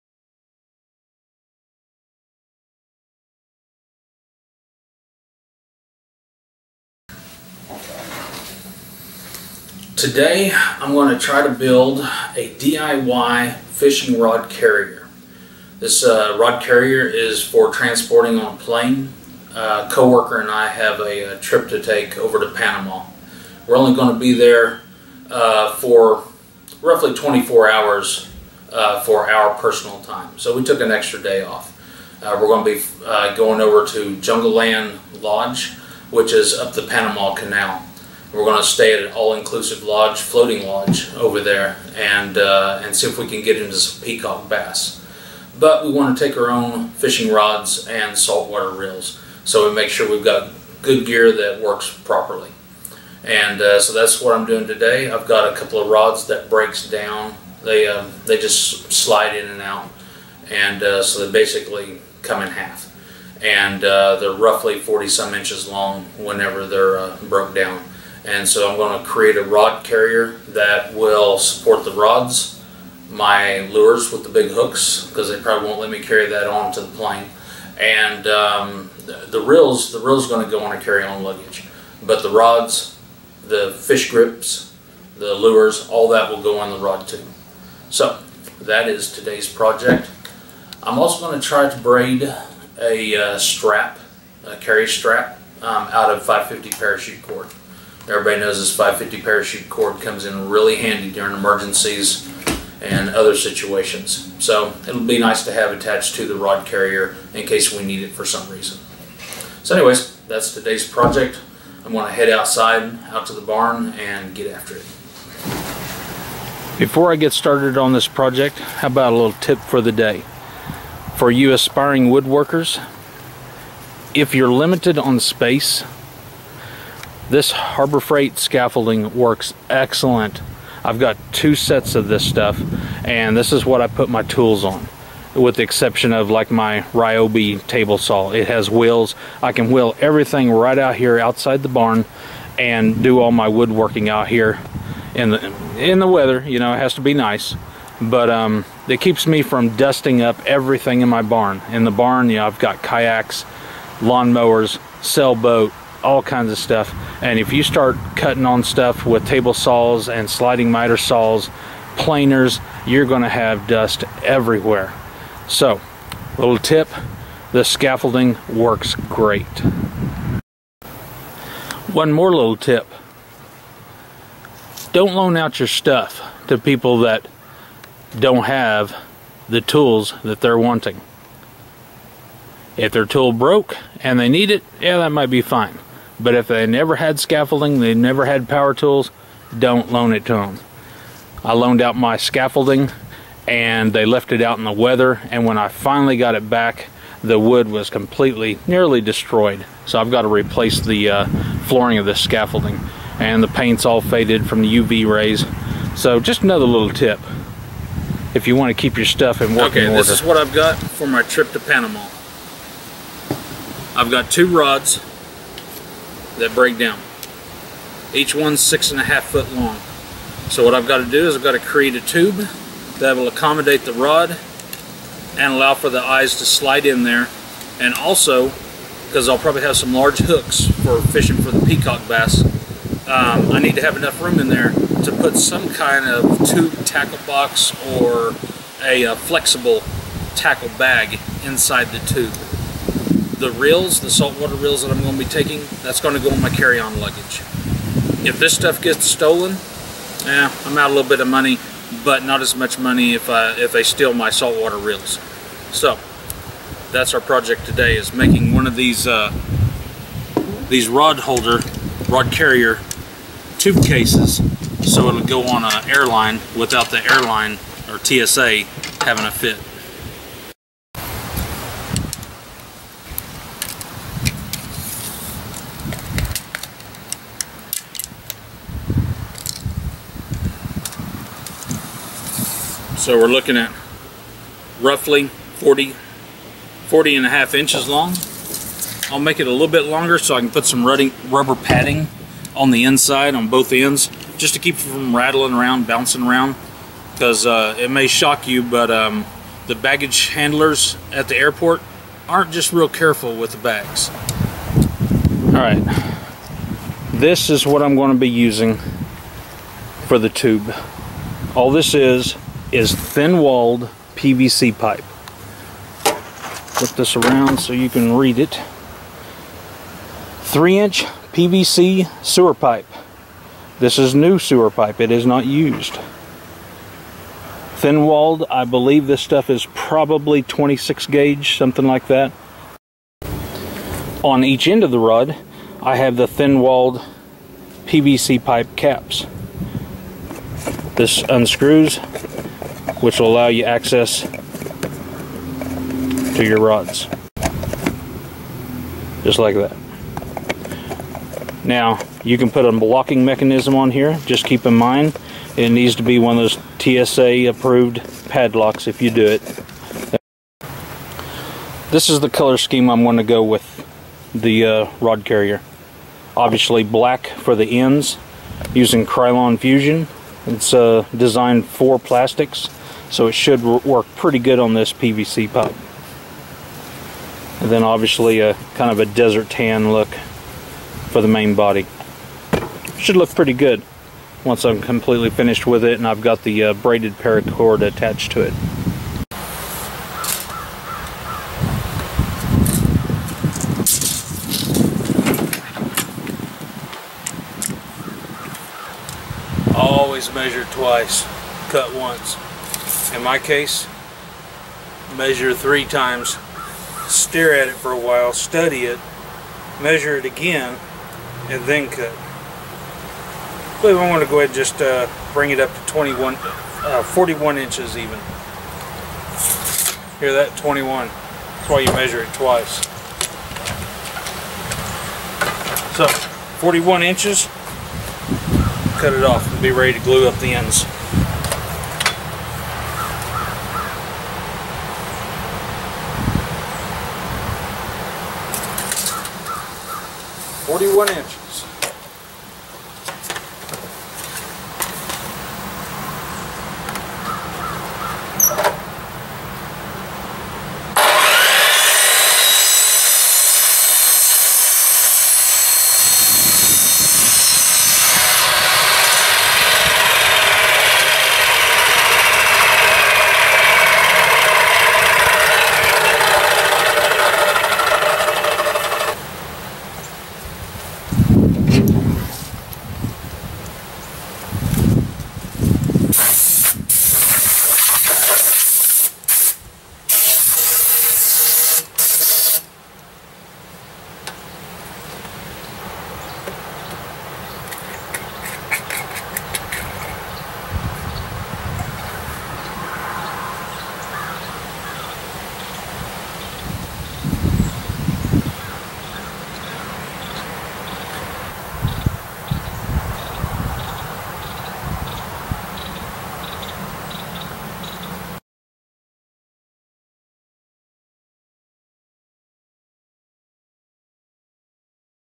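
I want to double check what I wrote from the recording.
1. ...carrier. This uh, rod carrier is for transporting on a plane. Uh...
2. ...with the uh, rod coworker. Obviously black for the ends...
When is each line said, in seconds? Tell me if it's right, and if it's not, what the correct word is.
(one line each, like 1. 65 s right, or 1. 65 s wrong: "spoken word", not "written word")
1. 14 s right
2. 363 s wrong: "carrier", not "coworker".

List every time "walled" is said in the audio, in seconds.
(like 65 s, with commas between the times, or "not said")
312 s, 327 s, 336 s.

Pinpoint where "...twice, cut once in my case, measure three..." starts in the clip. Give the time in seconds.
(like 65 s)
400 s.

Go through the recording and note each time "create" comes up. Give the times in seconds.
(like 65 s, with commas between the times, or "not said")
69 s, 221 s.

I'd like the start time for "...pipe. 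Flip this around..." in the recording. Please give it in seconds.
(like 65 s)
314 s.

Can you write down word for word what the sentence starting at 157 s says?
And if you start cutting on stuff with table saws and sliding miter saws, planers, you're going to have dust everywhere.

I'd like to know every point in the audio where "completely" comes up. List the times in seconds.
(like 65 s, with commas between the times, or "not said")
197 s, 384 s.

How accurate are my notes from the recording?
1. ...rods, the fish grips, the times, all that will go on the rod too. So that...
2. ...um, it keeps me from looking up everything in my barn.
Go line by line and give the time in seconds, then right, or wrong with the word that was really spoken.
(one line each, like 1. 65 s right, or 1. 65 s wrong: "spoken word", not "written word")
1. 82 s wrong: "lures", not "times"
2. 148 s wrong: "dusting", not "looking".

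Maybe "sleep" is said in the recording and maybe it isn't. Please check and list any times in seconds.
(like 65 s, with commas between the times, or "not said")
not said.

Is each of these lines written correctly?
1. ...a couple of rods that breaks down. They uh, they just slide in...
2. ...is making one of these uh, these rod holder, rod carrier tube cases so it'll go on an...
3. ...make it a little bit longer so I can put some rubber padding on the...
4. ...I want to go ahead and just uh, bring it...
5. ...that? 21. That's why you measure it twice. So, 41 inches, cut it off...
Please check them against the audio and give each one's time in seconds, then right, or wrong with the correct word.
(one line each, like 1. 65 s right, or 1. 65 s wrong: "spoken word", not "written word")
1. 55 s right
2. 257 s right
3. 289 s right
4. 413 s right
5. 420 s right.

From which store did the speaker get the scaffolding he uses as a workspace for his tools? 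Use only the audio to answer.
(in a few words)
Harbor Freight.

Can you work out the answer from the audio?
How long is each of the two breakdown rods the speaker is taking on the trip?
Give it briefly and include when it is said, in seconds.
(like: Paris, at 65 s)
6.5 feet, at 218 s.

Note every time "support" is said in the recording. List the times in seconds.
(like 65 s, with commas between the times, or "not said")
71 s.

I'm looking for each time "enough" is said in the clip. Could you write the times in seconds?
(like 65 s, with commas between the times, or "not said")
233 s.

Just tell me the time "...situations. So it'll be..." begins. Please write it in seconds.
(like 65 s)
103 s.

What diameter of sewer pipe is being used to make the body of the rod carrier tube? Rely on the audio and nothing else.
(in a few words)
3 inches.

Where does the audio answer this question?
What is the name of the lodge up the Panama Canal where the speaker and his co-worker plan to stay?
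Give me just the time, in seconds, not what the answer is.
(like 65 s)
34 s.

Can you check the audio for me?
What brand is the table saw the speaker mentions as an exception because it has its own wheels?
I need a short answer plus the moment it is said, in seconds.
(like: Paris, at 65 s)
Ryobi, at 136 s.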